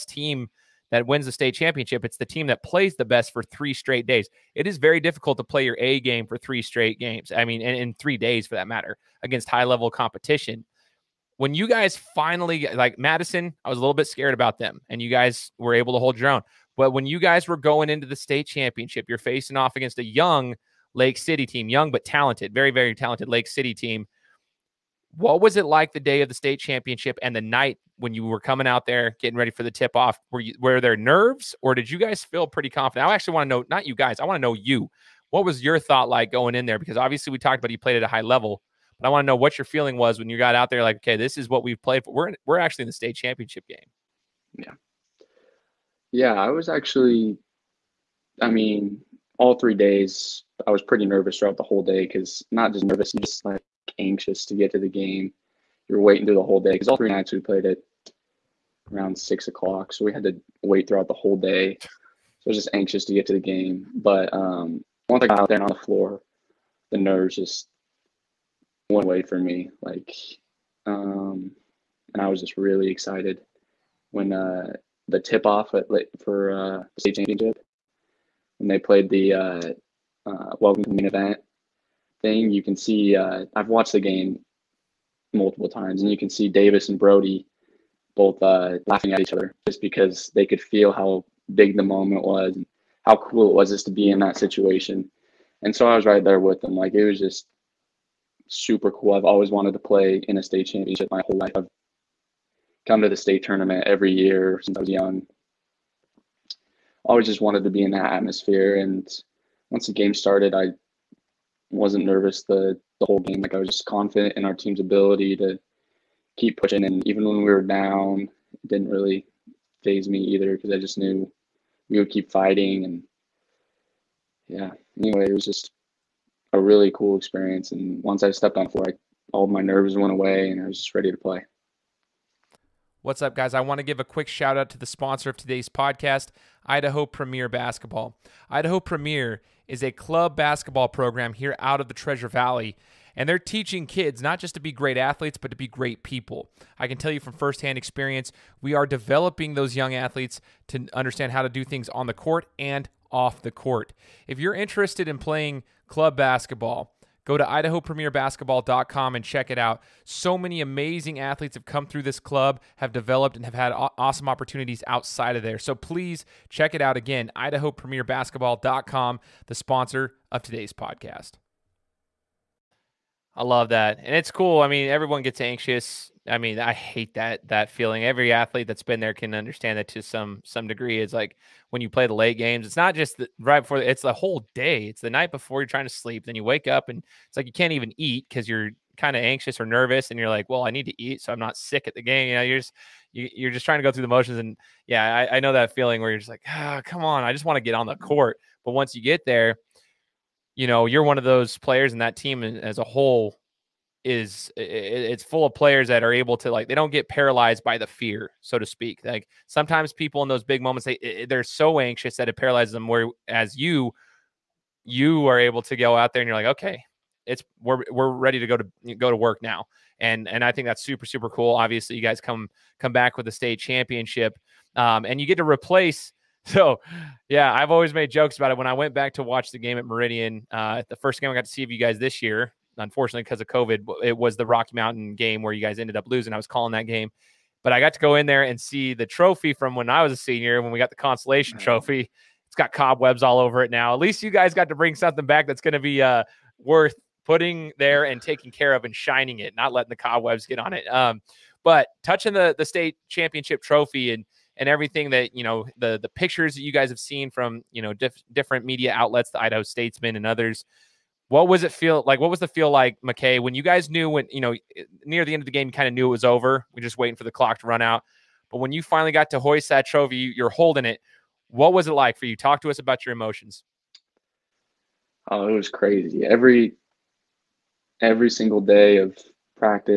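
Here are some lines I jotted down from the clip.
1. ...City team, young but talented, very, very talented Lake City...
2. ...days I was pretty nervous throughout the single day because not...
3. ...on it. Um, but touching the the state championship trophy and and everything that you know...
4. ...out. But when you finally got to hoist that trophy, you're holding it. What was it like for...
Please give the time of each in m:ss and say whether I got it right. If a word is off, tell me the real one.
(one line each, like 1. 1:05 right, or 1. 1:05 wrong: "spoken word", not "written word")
1. 0:21 right
2. 0:49 wrong: "whole", not "single"
3. 4:10 right
4. 4:27 right.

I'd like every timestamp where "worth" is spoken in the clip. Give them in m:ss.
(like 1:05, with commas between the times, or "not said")
4:06.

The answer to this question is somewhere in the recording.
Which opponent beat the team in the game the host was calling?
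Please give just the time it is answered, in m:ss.
3:54.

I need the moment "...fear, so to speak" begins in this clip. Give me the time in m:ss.
3:27.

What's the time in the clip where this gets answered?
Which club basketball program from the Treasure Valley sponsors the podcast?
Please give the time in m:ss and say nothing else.
2:16.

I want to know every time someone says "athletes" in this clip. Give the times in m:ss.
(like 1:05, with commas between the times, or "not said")
2:24, 2:29, 2:41, 2:58.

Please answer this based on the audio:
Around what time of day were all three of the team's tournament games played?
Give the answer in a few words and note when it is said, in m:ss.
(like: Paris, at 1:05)
6 o'clock, at 0:59.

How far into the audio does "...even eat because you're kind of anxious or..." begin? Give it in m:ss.
3:07.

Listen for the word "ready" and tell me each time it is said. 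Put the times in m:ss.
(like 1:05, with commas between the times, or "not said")
0:29, 2:10, 3:38.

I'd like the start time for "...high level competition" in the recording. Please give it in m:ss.
0:09.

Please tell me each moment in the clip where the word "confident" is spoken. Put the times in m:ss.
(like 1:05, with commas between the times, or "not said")
0:32, 1:53.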